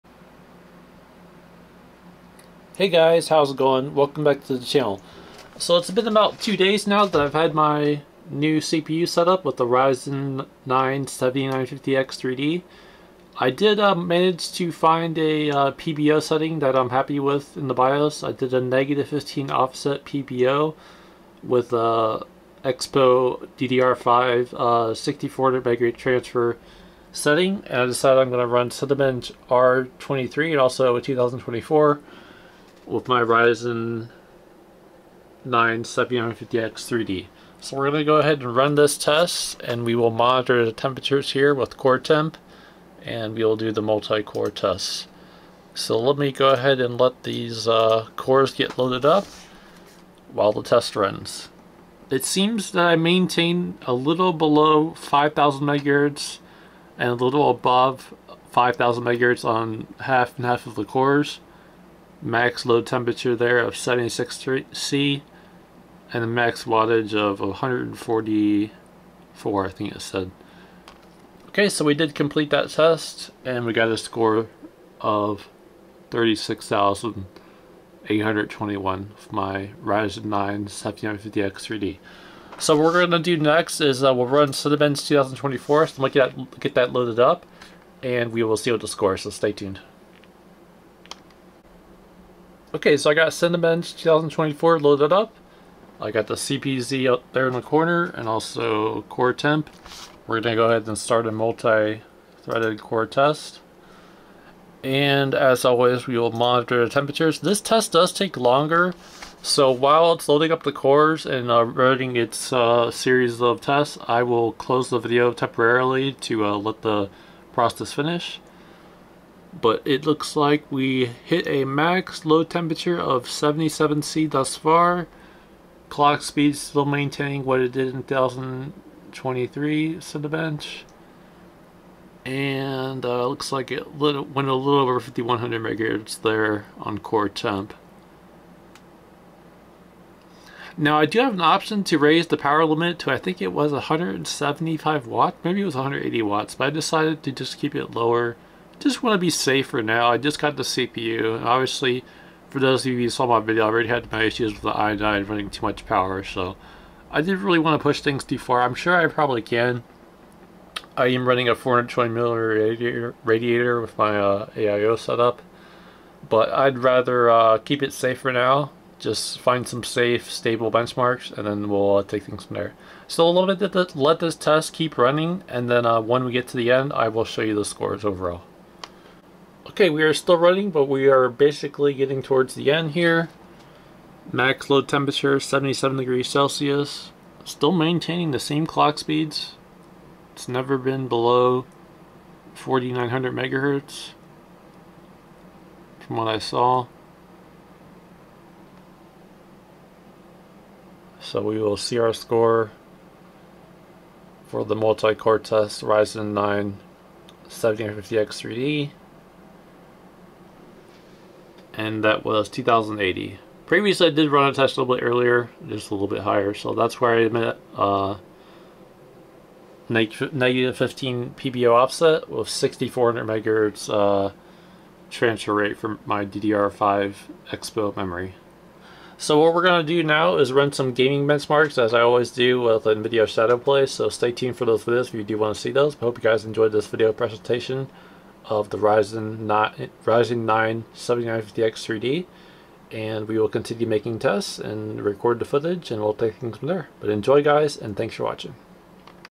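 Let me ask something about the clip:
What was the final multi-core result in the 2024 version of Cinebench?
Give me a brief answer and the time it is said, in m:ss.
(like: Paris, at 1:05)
2080, at 3:32.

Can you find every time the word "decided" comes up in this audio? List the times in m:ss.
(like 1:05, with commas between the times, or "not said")
0:27, 2:26.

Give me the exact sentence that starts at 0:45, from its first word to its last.
So let me go ahead and let these uh, cores get loaded up while the test runs.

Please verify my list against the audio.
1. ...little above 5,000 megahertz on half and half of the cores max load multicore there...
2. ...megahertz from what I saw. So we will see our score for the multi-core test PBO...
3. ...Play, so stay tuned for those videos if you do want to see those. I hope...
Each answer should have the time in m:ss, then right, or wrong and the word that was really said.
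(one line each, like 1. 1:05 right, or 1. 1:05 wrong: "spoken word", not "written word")
1. 0:57 wrong: "temperature", not "multicore"
2. 3:13 wrong: "Ryzen", not "PBO"
3. 3:53 right.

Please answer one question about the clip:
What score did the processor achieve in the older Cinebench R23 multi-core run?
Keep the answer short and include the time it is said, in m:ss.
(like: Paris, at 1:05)
36,821, at 1:16.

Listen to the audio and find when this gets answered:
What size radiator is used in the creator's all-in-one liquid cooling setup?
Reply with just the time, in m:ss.
2:41.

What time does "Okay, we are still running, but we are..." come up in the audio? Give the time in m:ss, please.
2:59.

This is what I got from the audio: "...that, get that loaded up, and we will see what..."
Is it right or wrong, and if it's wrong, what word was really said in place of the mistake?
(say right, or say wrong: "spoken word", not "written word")
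right.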